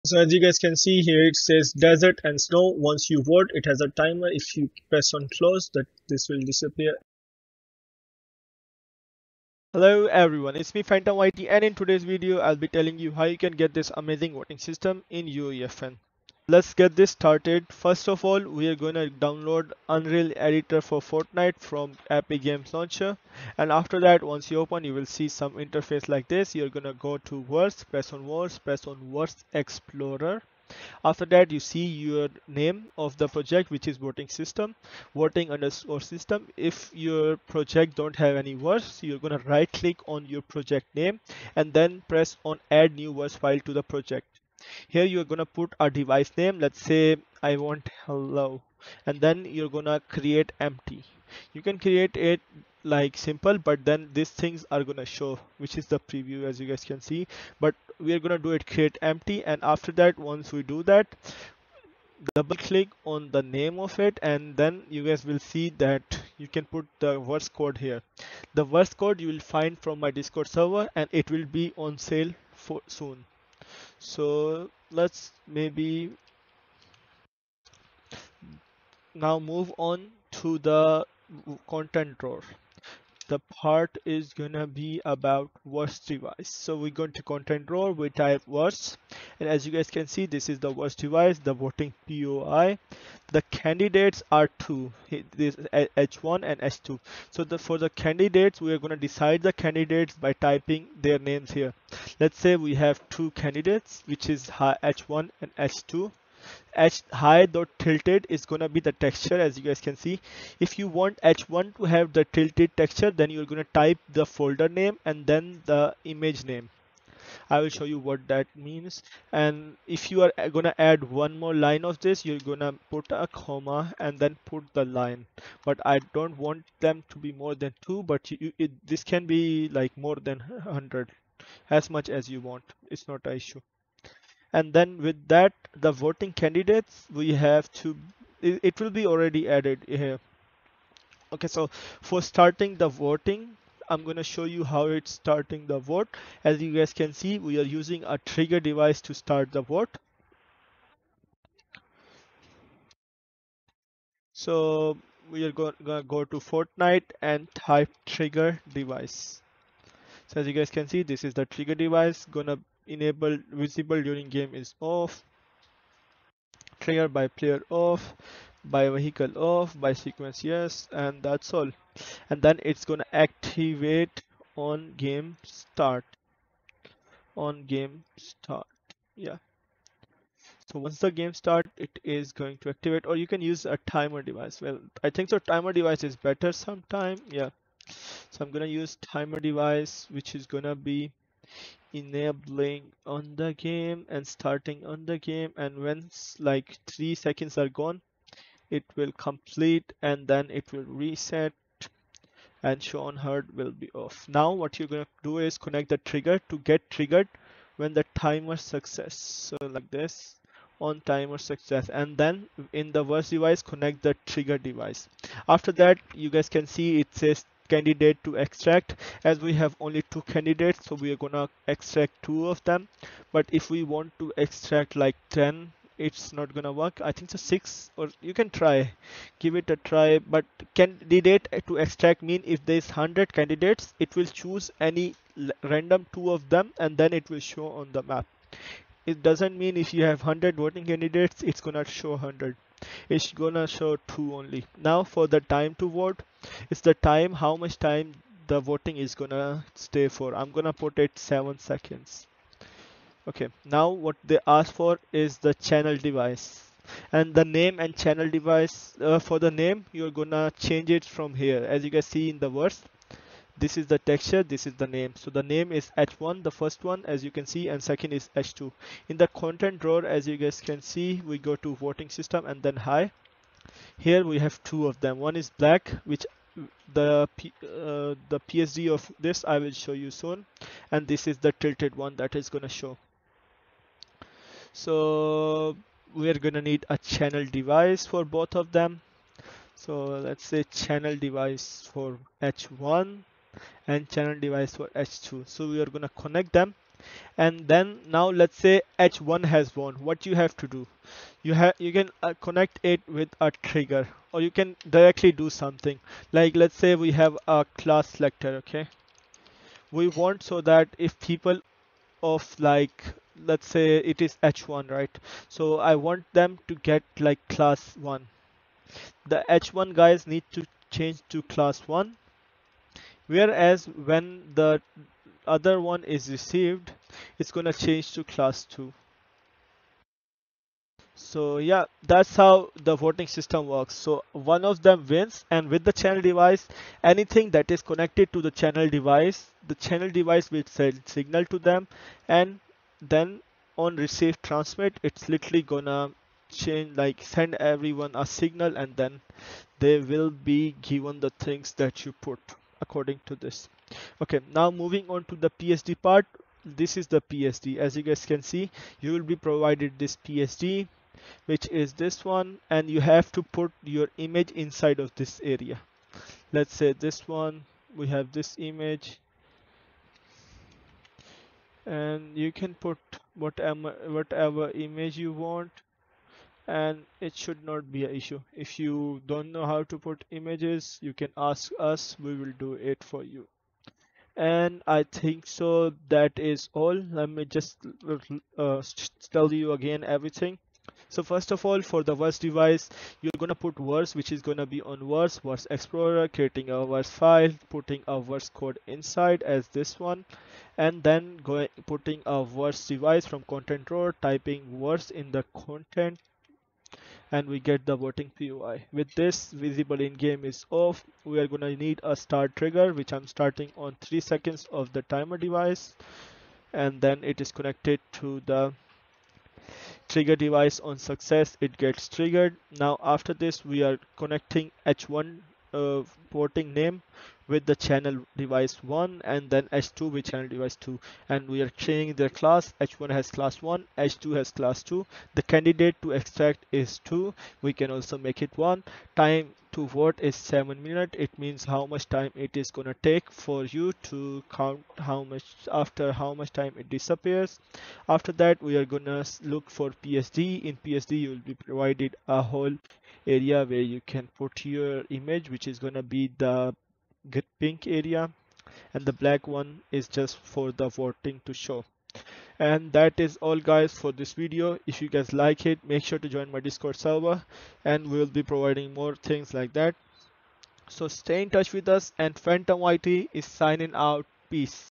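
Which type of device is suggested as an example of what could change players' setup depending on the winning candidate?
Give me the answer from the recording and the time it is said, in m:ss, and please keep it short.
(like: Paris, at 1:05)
class selector, at 5:07.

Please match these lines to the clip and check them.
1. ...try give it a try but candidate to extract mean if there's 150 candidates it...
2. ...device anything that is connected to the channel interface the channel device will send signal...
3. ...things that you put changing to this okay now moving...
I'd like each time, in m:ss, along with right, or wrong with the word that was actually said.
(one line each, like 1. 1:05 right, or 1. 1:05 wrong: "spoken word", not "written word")
1. 3:48 wrong: "100", not "150"
2. 5:36 wrong: "device", not "interface"
3. 5:51 wrong: "according", not "changing".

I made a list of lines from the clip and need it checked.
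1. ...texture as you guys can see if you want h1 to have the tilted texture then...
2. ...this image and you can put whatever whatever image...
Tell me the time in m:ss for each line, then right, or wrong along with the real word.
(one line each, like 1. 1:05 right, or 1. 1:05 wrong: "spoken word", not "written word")
1. 1:48 right
2. 6:08 right.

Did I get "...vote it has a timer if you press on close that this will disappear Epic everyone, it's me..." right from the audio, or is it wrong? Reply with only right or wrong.
wrong.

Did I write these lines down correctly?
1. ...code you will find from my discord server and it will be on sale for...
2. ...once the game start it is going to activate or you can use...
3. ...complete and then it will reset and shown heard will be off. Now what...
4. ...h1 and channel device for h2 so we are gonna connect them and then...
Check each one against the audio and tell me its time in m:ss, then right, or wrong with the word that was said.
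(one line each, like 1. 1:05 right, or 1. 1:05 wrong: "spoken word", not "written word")
1. 1:08 right
2. 3:00 right
3. 3:19 right
4. 4:52 right.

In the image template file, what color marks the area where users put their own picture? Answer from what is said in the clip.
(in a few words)
pink.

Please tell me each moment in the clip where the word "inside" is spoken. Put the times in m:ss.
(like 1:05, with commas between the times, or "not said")
6:04, 6:38.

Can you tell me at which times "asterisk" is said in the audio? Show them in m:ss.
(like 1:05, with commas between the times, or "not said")
not said.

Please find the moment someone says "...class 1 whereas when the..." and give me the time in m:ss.
5:21.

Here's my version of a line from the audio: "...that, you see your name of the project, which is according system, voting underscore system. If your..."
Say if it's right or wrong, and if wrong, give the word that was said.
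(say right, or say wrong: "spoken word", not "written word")
wrong: "voting", not "according".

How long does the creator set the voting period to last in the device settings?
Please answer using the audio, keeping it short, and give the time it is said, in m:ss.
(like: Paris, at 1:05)
7 seconds, at 4:11.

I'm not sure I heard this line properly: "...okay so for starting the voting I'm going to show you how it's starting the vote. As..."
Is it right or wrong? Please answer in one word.
right.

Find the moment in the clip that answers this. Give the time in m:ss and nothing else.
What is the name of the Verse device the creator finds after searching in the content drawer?
1:31.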